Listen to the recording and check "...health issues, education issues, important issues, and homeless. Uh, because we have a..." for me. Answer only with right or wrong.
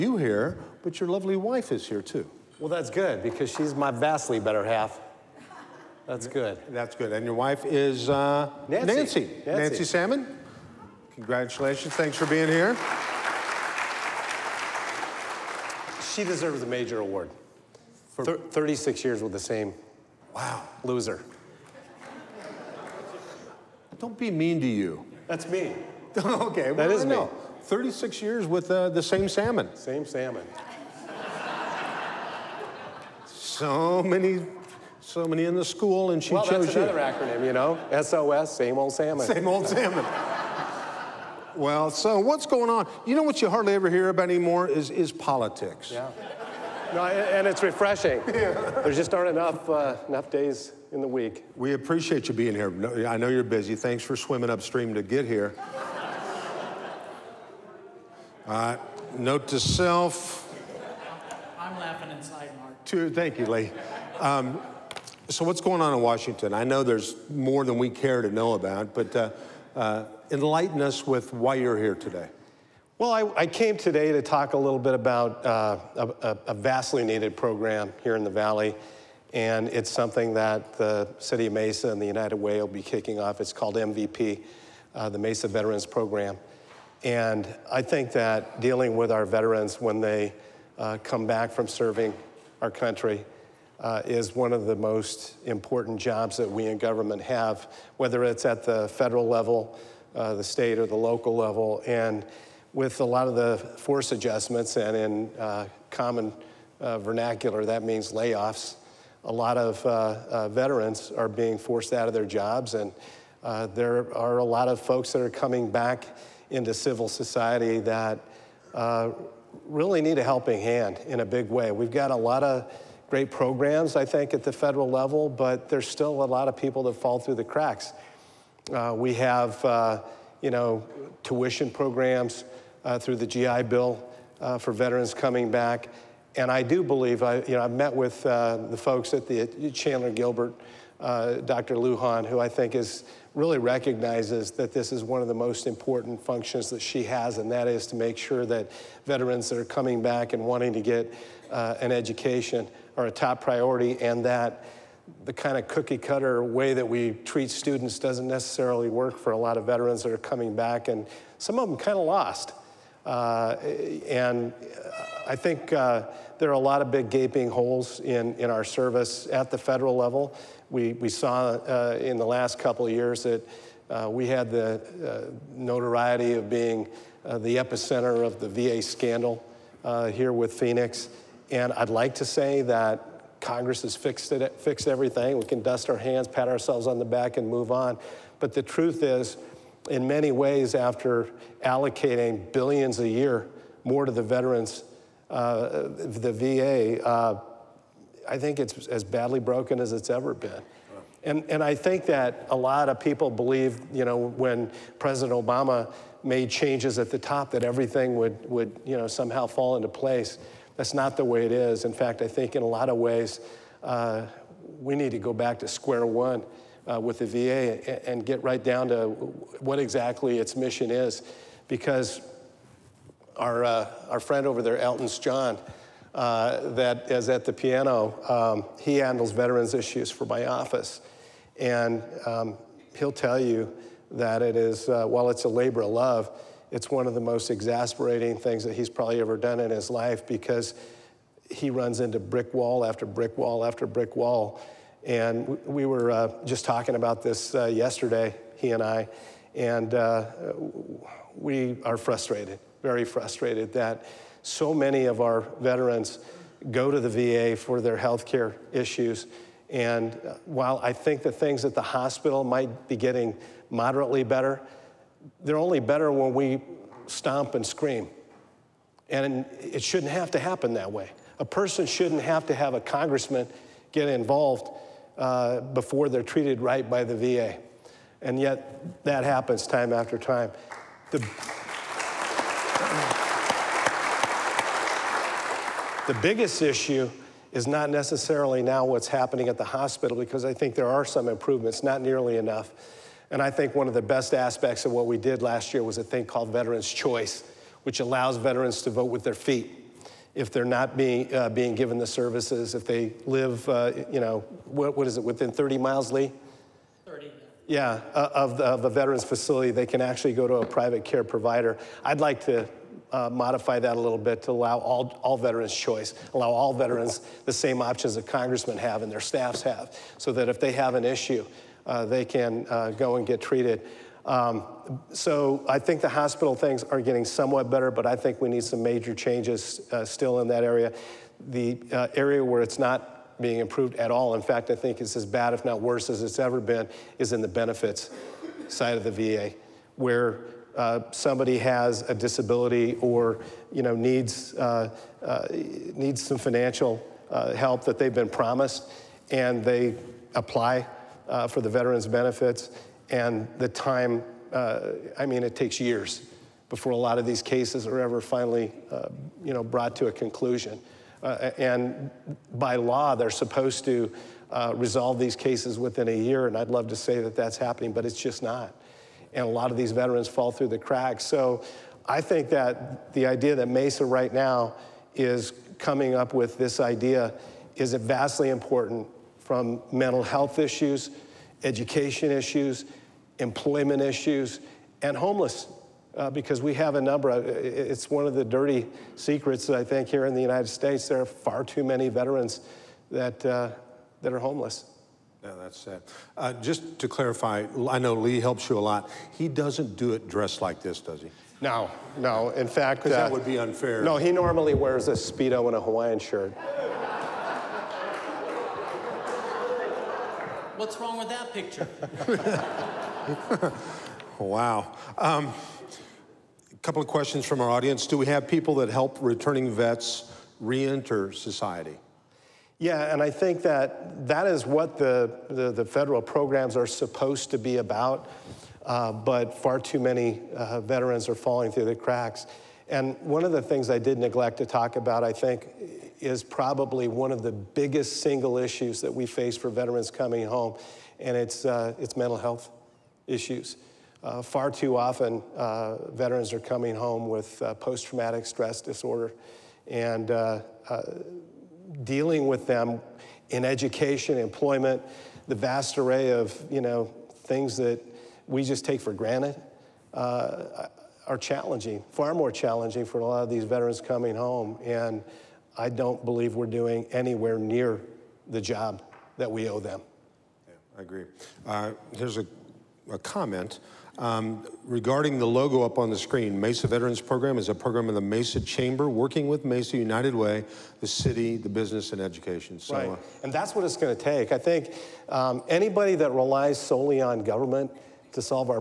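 wrong.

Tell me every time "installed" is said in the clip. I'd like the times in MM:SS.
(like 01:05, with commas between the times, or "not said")
not said.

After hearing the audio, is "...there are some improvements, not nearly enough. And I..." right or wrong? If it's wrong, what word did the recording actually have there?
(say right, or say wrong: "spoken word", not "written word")
right.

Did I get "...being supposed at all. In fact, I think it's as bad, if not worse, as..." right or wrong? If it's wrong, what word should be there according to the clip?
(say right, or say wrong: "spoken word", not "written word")
wrong: "improved", not "supposed".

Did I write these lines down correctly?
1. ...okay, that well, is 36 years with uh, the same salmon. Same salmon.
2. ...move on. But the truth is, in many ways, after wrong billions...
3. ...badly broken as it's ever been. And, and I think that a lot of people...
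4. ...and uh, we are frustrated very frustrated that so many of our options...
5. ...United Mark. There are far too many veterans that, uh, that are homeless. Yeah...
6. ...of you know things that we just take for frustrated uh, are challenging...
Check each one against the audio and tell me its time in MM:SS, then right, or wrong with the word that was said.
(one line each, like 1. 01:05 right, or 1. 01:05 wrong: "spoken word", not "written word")
1. 00:26 right
2. 03:07 wrong: "allocating", not "wrong"
3. 03:19 right
4. 04:09 wrong: "veterans", not "options"
5. 06:30 wrong: "States", not "Mark"
6. 07:36 wrong: "granted", not "frustrated".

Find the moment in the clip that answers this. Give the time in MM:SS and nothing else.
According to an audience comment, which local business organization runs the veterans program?
07:58.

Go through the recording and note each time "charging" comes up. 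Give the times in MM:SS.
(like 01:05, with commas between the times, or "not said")
not said.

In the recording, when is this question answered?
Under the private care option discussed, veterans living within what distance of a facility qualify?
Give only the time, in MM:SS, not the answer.
05:05.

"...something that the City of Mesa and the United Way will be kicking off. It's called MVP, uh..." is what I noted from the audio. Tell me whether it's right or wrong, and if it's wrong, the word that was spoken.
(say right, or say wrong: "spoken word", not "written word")
right.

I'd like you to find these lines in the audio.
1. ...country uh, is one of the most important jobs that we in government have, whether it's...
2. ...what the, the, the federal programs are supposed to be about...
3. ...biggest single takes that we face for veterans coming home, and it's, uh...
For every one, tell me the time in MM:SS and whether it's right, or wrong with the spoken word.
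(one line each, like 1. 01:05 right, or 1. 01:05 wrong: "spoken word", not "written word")
1. 01:32 right
2. 07:04 right
3. 07:17 wrong: "issues", not "takes".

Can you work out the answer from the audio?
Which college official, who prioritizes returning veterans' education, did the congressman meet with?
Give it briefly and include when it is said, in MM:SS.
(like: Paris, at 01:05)
Dr. Lujan, at 02:21.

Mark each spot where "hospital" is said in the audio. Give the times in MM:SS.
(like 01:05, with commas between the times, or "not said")
04:21, 04:49, 05:26.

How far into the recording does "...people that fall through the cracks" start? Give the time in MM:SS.
02:06.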